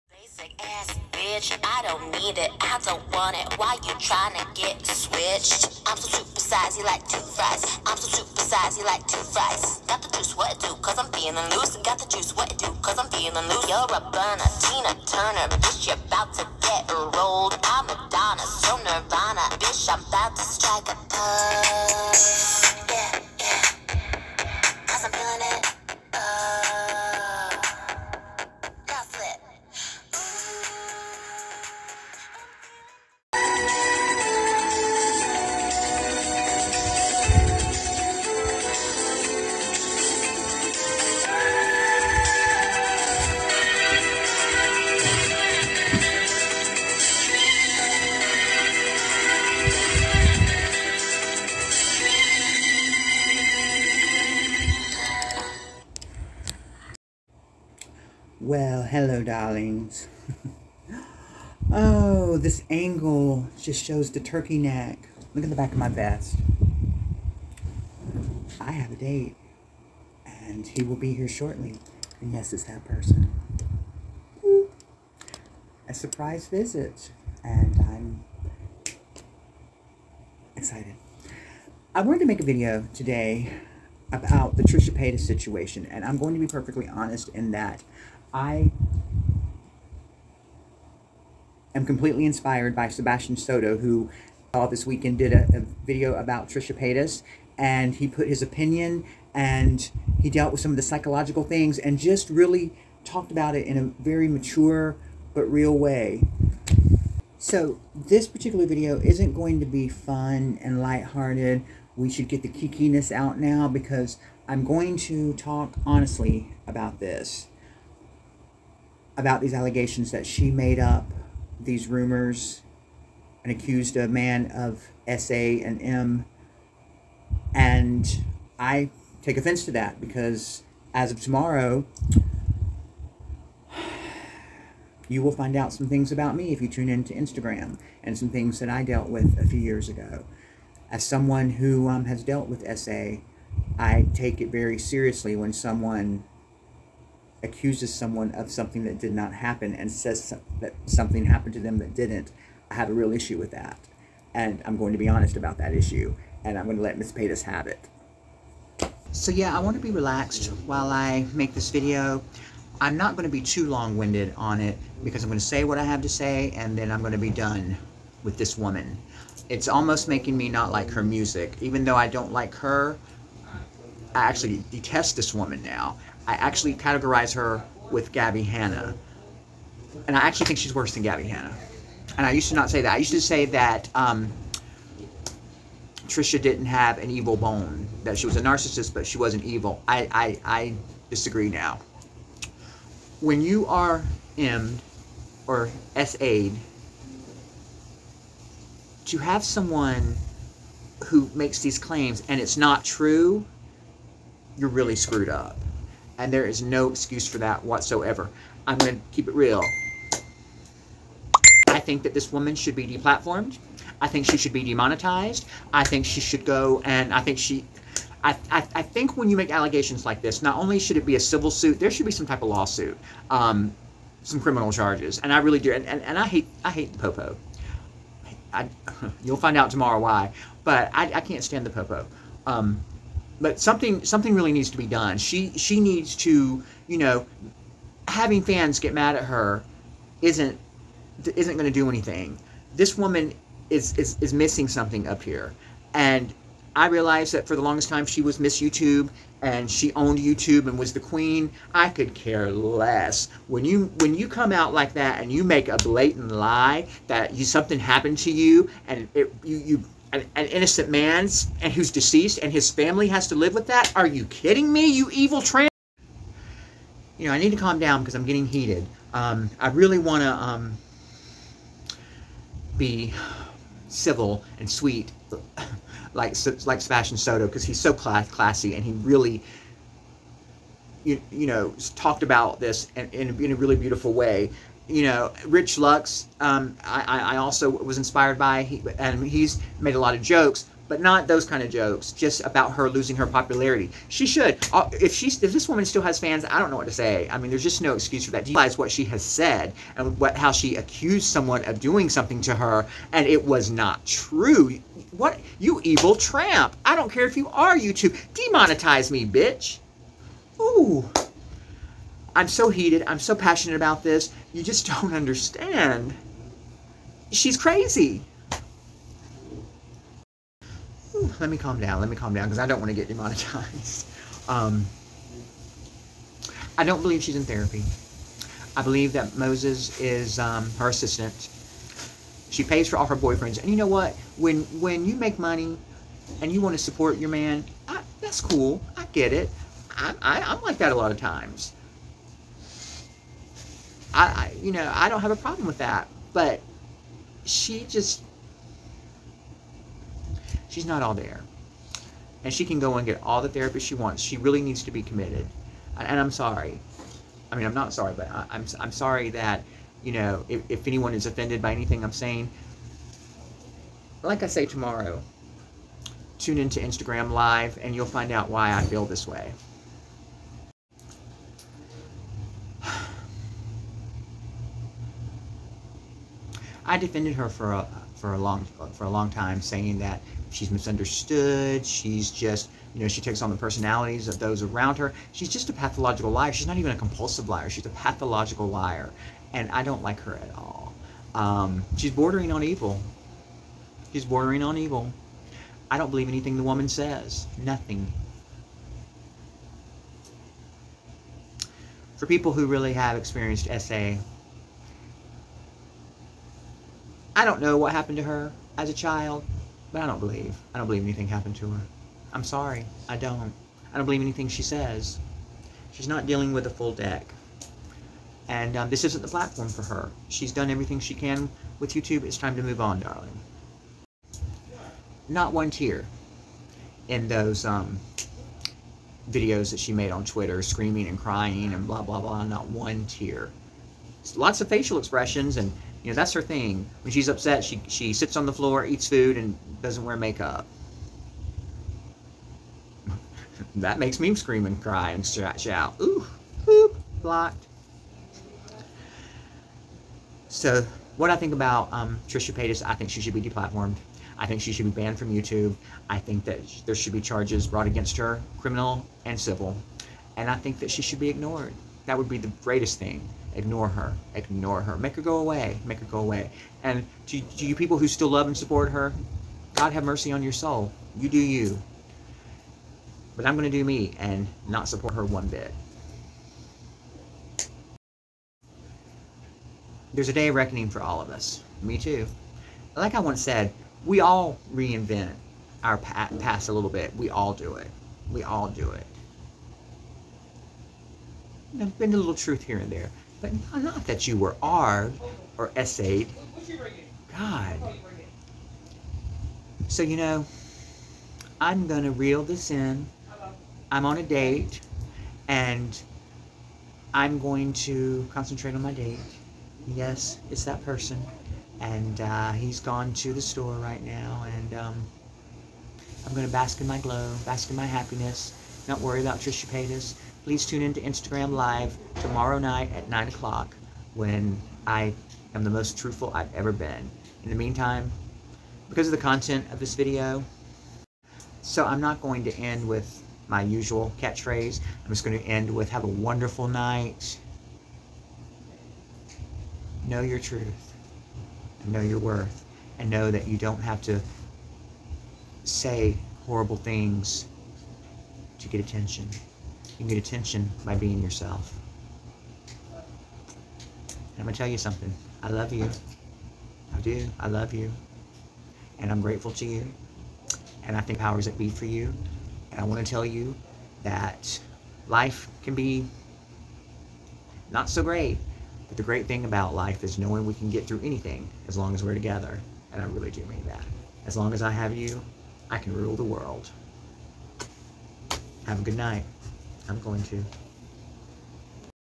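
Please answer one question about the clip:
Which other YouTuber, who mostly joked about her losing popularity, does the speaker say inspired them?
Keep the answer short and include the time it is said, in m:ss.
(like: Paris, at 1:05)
Rich Lux, at 4:45.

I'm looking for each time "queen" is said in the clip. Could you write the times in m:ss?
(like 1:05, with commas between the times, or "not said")
4:10.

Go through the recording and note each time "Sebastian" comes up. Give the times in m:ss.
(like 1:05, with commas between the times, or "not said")
1:32, 4:36.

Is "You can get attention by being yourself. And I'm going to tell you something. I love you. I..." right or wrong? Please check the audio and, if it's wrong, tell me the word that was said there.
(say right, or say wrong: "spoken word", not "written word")
right.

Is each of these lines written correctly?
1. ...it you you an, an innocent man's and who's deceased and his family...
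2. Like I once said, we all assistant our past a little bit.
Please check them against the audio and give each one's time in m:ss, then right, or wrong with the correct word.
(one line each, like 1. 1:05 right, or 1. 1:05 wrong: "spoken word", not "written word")
1. 4:19 right
2. 8:02 wrong: "reinvent", not "assistant".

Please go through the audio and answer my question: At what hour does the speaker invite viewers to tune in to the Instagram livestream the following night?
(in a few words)
9 o'clock.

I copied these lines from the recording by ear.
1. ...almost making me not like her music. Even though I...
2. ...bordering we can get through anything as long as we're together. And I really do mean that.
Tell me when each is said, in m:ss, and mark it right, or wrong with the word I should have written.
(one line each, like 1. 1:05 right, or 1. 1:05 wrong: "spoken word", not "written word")
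1. 2:49 right
2. 9:30 wrong: "knowing", not "bordering".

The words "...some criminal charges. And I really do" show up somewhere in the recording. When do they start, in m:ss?
3:44.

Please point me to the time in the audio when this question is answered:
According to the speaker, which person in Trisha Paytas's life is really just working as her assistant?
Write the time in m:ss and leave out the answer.
5:29.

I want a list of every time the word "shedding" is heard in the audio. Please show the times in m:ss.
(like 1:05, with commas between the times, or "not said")
not said.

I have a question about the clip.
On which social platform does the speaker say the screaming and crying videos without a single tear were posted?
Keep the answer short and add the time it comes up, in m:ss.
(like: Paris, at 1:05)
Twitter, at 7:10.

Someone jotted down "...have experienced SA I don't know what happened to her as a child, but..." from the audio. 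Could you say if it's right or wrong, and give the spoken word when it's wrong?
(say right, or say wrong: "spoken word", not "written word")
right.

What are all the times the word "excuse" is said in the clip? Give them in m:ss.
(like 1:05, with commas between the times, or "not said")
3:26, 4:57.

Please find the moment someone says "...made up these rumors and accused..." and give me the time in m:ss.
2:00.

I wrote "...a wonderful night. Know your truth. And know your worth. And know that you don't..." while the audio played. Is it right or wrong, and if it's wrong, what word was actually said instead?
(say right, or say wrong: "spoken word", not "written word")
right.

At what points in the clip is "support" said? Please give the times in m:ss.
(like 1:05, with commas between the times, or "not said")
5:36, 7:48, 7:54.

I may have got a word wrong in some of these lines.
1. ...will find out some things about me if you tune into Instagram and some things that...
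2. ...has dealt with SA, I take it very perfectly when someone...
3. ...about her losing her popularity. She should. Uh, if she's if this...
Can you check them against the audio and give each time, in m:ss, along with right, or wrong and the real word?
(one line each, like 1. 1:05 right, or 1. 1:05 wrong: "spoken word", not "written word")
1. 2:15 right
2. 2:22 wrong: "seriously", not "perfectly"
3. 4:52 right.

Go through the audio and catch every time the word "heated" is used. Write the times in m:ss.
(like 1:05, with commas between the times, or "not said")
4:28, 5:12.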